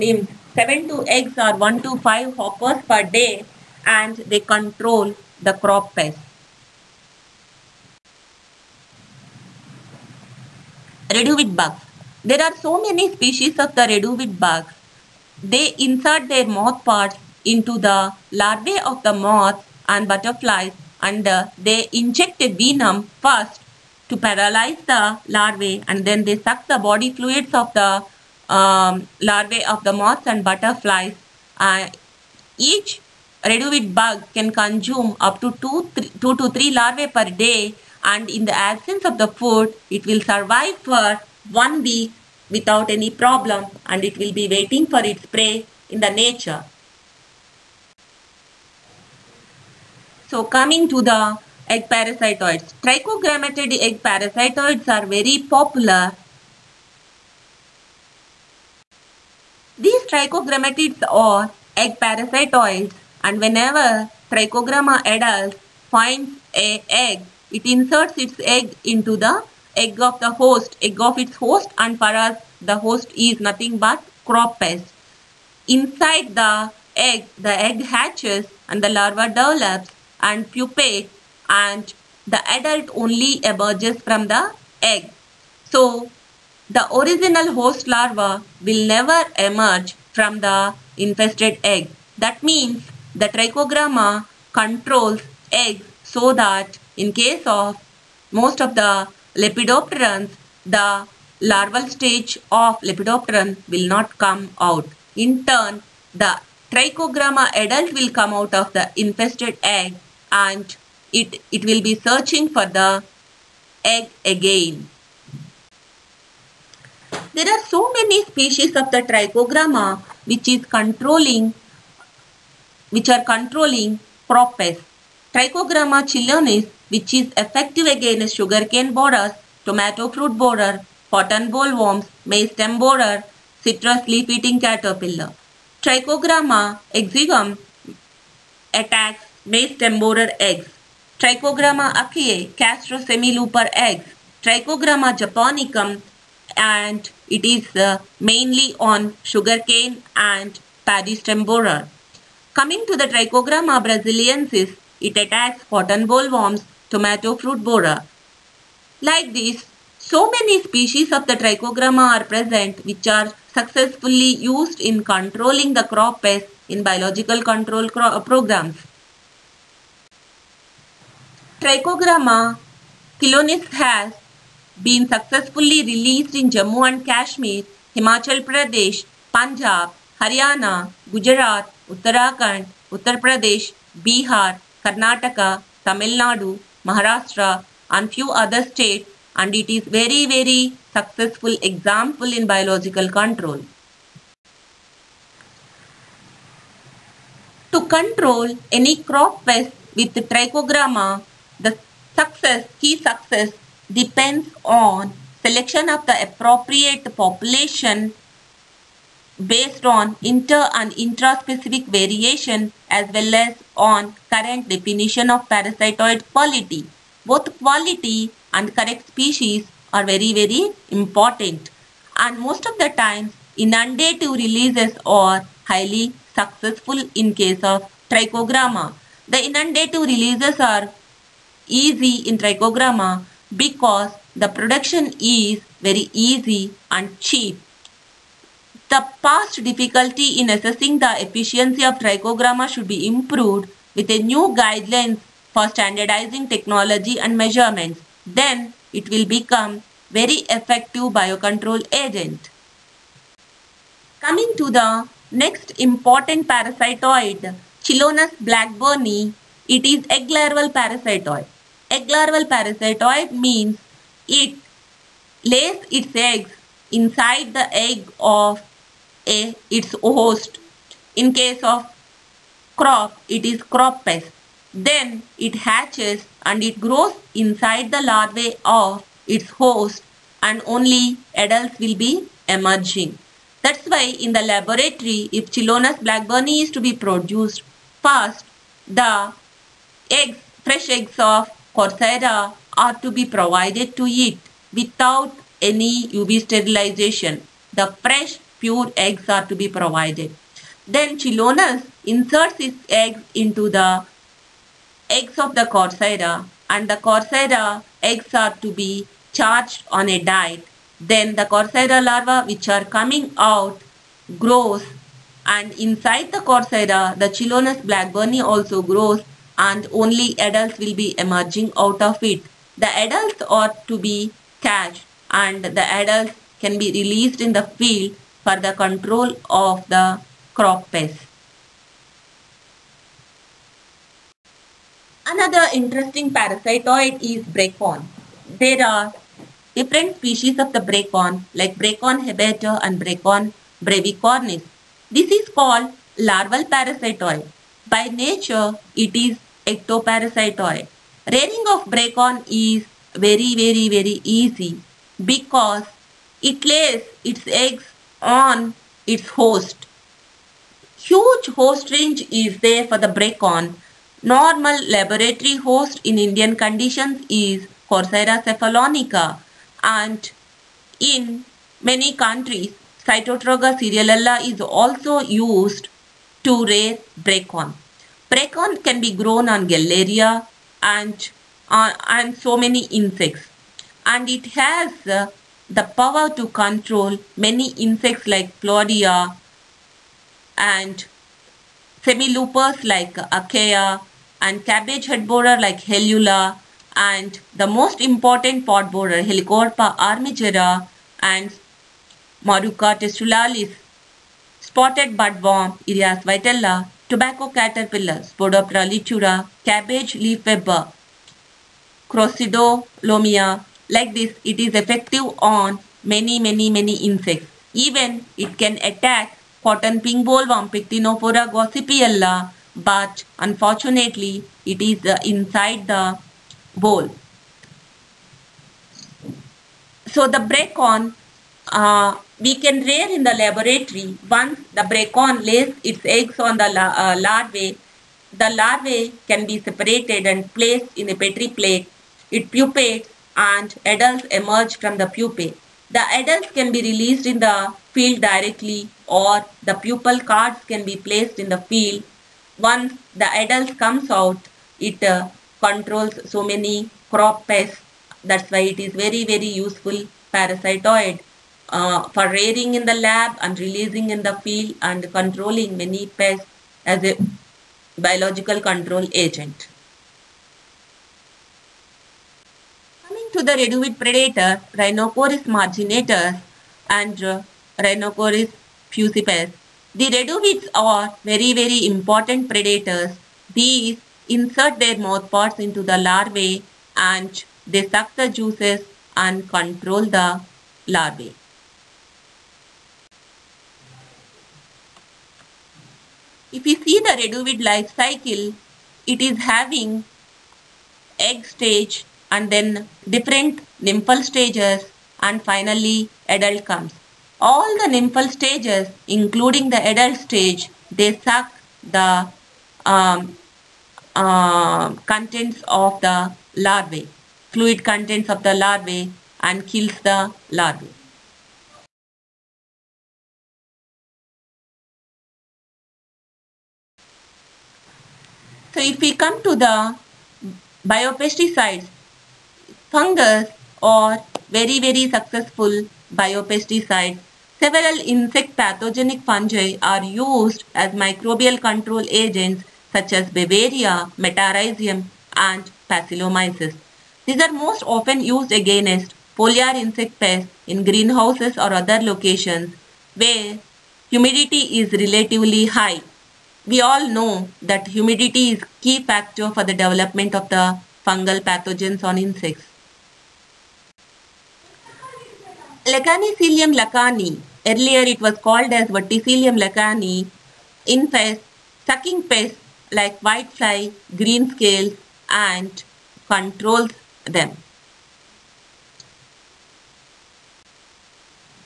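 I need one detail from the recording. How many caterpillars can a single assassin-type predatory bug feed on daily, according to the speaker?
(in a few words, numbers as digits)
2 to 3.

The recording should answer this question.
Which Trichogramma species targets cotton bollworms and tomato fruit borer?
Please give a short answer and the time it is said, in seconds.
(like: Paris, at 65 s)
Trichogramma brasiliensis, at 153 s.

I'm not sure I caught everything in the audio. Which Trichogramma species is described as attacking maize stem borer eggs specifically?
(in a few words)
Trichogramma exiguum.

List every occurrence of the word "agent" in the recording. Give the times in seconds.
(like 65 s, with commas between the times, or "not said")
251 s, 469 s, 542 s.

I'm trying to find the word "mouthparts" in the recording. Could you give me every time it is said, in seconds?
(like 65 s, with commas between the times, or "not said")
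16 s, 485 s.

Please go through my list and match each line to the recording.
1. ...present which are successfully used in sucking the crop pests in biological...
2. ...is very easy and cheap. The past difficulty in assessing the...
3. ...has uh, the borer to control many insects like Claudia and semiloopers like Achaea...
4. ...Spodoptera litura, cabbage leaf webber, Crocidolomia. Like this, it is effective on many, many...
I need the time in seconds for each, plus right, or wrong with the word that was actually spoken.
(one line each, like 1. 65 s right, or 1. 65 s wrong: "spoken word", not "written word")
1. 162 s wrong: "controlling", not "sucking"
2. 235 s right
3. 384 s wrong: "power", not "borer"
4. 408 s right.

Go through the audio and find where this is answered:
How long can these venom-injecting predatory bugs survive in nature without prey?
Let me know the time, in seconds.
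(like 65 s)
41 s.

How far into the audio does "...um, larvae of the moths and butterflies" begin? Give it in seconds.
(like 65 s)
28 s.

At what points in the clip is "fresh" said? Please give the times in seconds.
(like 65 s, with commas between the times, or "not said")
290 s, 298 s.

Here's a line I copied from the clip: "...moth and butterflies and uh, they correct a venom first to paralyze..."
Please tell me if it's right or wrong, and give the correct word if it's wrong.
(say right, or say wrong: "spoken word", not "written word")
wrong: "inject", not "correct".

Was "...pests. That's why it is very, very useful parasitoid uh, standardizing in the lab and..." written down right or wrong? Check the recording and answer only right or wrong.
wrong.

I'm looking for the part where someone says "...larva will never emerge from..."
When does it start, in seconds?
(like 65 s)
87 s.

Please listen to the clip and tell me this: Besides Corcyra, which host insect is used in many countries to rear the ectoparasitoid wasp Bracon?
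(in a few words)
Sitotroga cerealella.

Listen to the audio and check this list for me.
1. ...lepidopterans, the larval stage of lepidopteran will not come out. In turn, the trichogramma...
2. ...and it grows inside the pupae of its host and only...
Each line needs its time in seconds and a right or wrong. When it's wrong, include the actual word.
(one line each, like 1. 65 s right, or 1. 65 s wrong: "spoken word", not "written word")
1. 99 s right
2. 276 s wrong: "larvae", not "pupae".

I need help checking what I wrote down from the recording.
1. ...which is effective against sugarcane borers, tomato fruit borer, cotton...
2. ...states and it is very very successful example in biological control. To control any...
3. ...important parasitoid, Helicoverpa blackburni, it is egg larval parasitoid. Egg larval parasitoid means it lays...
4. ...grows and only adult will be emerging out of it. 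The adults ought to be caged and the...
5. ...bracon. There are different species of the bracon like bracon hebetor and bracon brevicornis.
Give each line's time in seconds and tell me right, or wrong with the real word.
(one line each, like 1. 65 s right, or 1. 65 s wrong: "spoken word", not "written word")
1. 126 s right
2. 188 s right
3. 255 s wrong: "Chelonus", not "Helicoverpa"
4. 318 s right
5. 337 s right.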